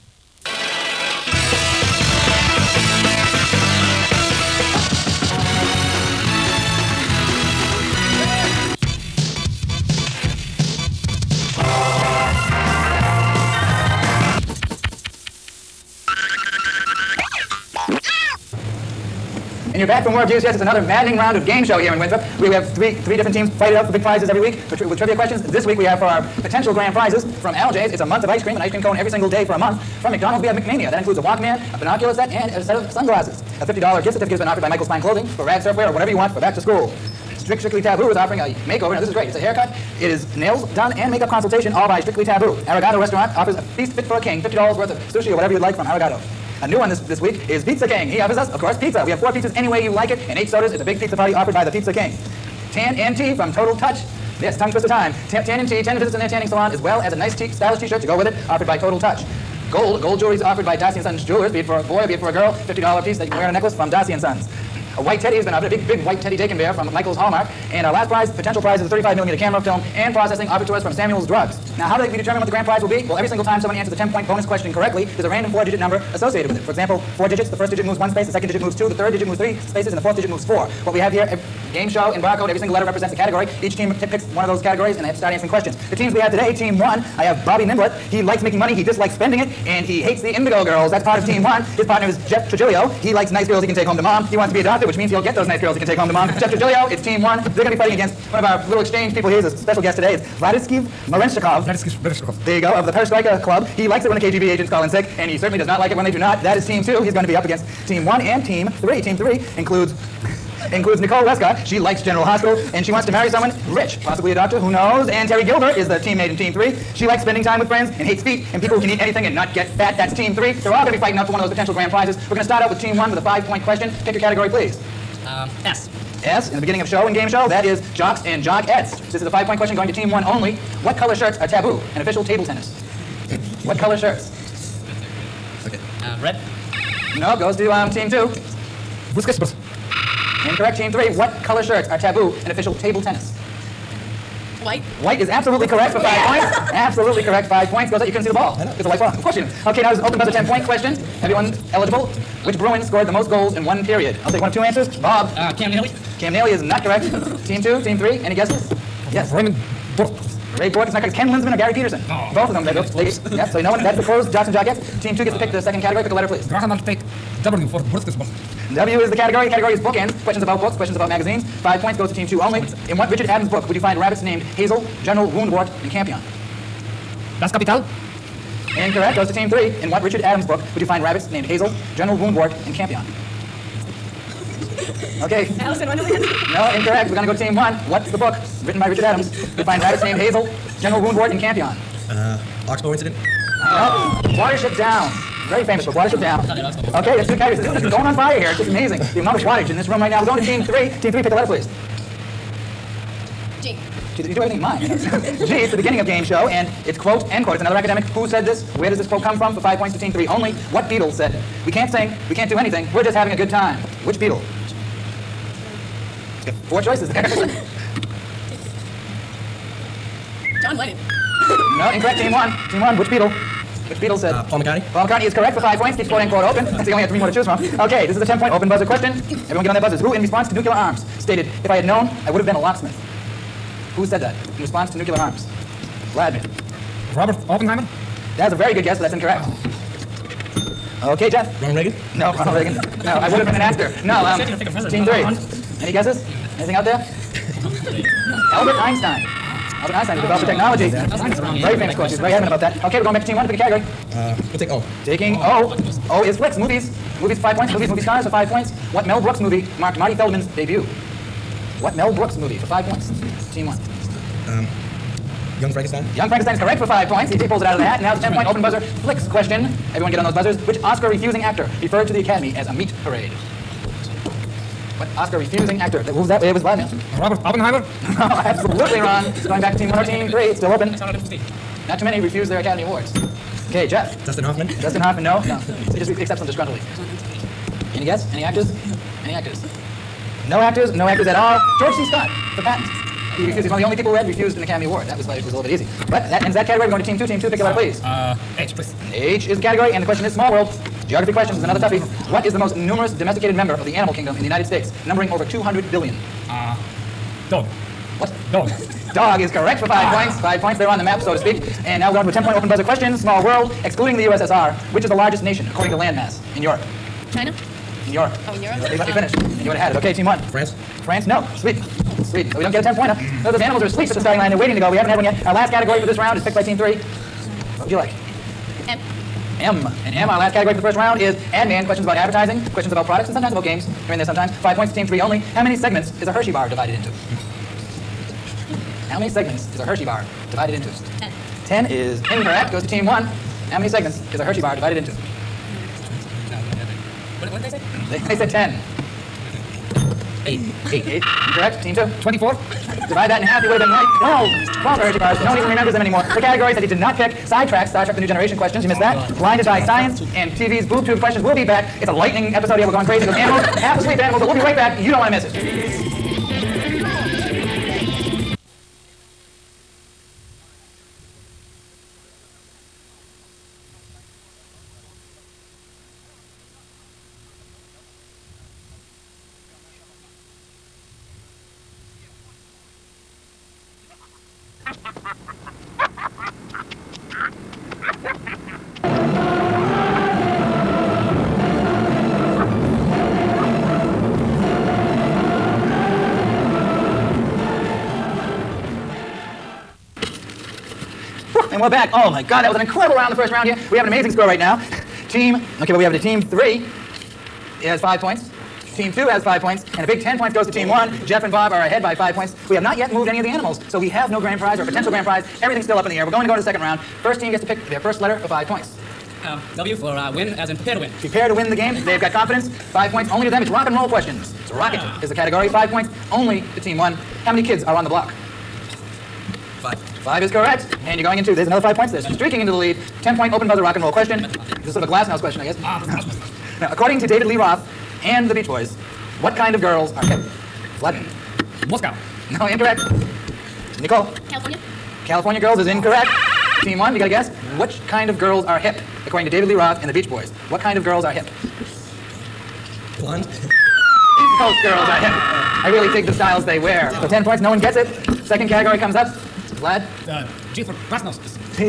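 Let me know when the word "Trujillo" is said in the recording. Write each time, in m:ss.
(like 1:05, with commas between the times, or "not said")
1:32, 1:36.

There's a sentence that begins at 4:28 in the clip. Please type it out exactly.
Now it's a 10 point open buzzer flicks question.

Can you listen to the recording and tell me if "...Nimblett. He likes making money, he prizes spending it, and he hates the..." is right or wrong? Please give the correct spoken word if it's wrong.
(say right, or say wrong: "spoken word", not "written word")
wrong: "dislikes", not "prizes".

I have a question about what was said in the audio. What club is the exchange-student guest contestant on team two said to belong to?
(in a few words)
Perestroika Club.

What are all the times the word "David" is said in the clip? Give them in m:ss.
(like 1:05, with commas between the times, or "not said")
7:17, 7:29.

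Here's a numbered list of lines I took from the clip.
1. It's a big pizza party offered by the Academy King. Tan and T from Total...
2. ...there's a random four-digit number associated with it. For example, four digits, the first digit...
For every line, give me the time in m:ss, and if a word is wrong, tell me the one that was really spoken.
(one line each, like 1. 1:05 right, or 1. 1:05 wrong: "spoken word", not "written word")
1. 0:50 wrong: "Pizza", not "Academy"
2. 1:15 right.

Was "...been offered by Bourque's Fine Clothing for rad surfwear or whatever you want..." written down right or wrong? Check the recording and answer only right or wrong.
wrong.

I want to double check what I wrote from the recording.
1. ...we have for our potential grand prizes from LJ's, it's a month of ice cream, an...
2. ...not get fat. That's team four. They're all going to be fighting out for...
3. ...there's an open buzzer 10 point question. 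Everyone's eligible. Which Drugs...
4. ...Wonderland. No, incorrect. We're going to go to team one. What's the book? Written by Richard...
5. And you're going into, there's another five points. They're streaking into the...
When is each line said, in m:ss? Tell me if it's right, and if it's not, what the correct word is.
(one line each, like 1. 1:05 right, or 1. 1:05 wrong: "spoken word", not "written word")
1. 0:25 right
2. 1:59 wrong: "three", not "four"
3. 2:29 wrong: "Bruin", not "Drugs"
4. 3:05 right
5. 7:11 right.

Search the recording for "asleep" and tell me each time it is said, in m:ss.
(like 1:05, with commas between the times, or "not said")
5:23, 6:03.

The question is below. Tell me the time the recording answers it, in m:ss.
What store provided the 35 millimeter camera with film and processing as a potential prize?
1:10.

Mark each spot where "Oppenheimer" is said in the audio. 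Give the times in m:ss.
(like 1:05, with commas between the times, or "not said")
3:57, 4:37.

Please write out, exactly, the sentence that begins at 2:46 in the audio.
Graham, I'll take W for Brewster's W is the category.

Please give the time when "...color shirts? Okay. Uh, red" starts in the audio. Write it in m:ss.
2:13.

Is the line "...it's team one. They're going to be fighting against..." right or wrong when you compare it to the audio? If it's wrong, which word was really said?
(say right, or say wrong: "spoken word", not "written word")
right.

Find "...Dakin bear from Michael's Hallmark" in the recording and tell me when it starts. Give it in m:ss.
1:06.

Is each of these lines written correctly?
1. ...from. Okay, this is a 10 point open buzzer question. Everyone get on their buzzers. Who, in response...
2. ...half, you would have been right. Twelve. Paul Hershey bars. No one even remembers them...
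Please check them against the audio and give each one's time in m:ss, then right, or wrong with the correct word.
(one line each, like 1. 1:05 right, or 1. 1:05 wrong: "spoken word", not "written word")
1. 3:47 right
2. 5:53 right.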